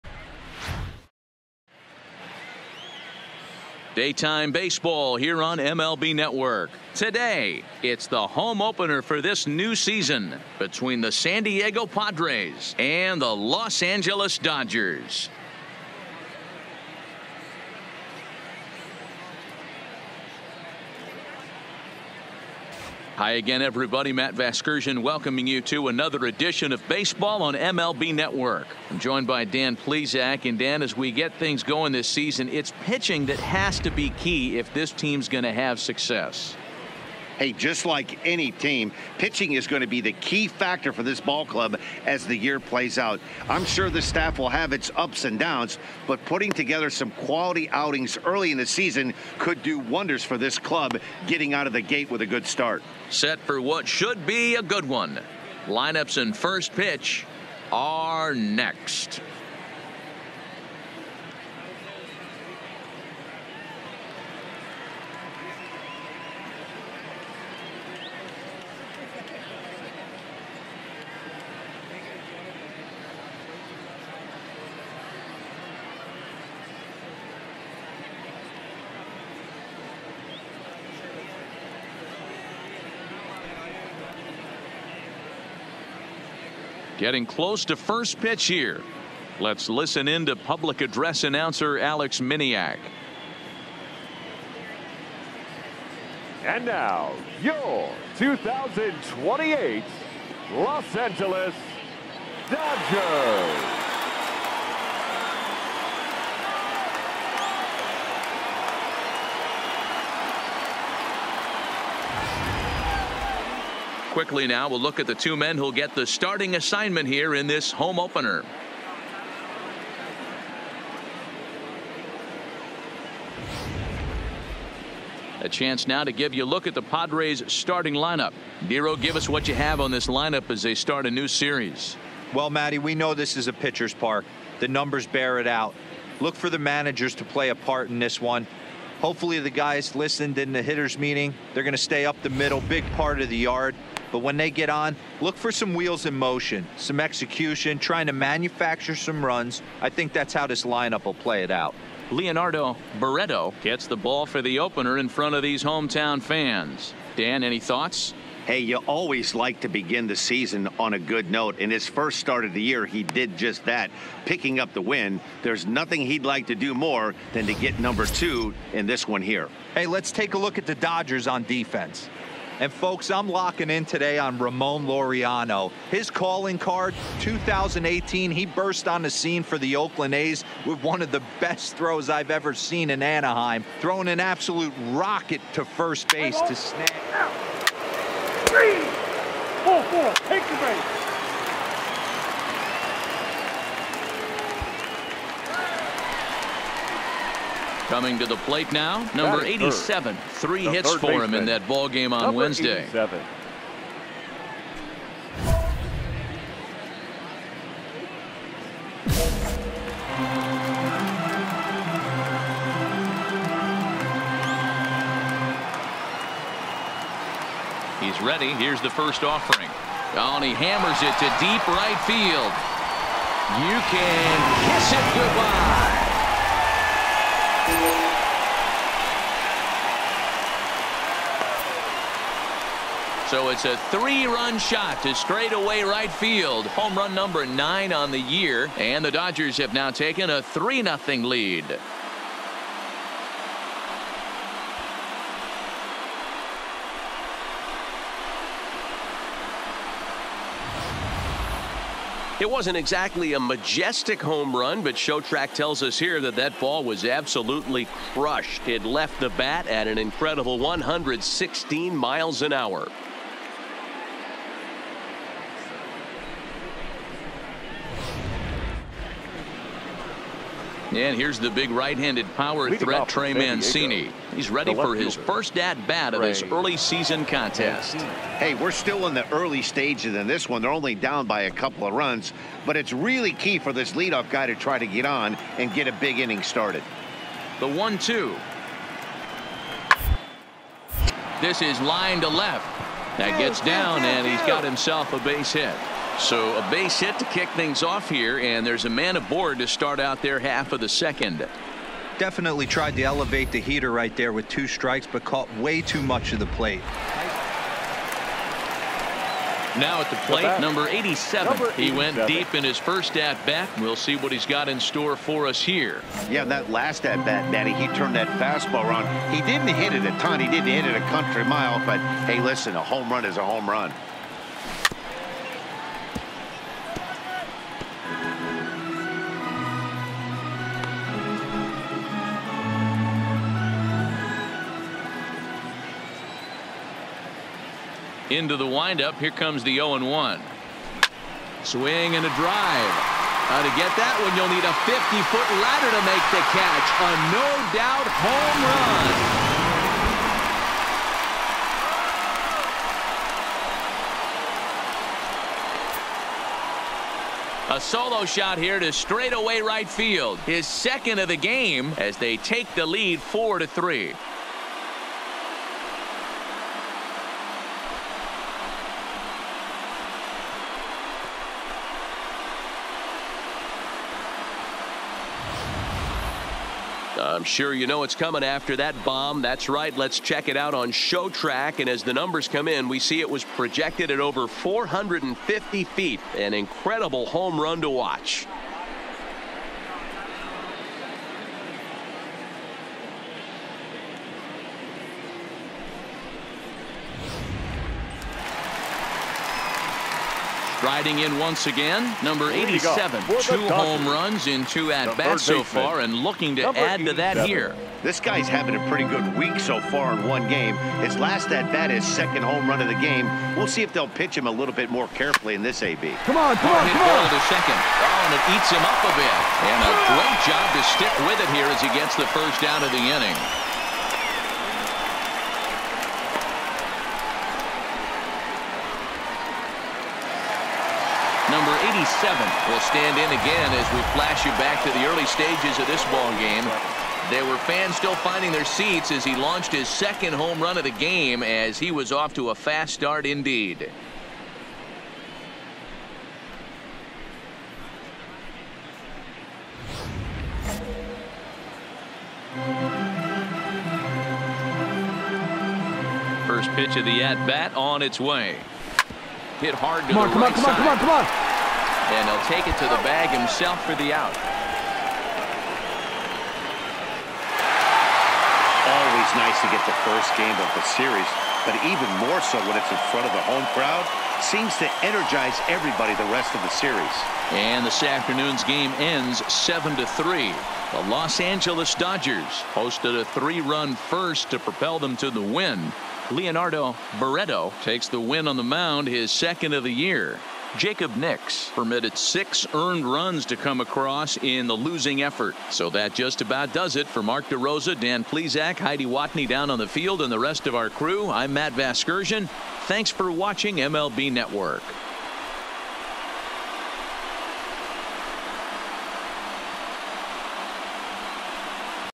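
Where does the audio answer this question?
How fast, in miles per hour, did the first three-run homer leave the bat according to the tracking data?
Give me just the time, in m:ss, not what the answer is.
4:20.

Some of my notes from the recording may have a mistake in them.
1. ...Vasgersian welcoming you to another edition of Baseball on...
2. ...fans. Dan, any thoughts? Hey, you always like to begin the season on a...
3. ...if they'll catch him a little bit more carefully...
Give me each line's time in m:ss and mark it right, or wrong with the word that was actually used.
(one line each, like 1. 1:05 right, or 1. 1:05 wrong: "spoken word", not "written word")
1. 0:24 right
2. 2:36 right
3. 6:53 wrong: "pitch", not "catch".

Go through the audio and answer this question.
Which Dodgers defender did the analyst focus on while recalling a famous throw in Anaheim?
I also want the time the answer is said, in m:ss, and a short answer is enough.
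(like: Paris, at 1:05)
Ramon Laureano, at 2:54.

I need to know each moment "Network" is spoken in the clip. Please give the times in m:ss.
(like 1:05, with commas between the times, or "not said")
0:06, 0:28, 8:24.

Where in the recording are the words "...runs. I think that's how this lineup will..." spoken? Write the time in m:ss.
2:29.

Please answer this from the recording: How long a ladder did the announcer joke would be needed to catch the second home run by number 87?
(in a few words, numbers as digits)
50-foot.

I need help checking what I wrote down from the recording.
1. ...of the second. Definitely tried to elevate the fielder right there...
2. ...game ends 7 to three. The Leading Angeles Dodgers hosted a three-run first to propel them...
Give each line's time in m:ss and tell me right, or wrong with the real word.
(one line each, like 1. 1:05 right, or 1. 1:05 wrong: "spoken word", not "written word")
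1. 5:00 wrong: "heater", not "fielder"
2. 7:58 wrong: "Los", not "Leading".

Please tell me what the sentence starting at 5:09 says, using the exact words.
Now at the plate, number 87.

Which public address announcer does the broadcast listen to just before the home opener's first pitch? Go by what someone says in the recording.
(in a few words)
Alex Miniak.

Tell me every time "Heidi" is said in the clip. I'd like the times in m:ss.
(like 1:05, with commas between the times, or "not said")
8:18.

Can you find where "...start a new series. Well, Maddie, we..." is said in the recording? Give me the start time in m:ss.
2:10.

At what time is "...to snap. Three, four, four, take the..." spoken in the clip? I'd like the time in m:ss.
3:06.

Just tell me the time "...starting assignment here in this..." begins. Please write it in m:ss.
1:56.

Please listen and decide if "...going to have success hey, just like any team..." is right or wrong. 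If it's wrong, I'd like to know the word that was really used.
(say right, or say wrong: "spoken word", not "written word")
right.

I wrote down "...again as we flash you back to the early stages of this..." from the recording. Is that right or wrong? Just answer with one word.
right.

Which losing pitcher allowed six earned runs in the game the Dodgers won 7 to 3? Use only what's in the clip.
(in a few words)
Jacob Nix.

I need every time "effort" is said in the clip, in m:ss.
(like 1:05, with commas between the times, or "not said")
8:15.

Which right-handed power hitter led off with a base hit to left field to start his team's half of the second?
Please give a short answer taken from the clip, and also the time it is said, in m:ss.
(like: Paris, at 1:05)
Trey Mancini, at 4:33.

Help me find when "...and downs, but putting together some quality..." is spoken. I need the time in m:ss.
0:45.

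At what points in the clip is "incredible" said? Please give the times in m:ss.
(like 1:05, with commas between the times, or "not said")
4:19, 6:26.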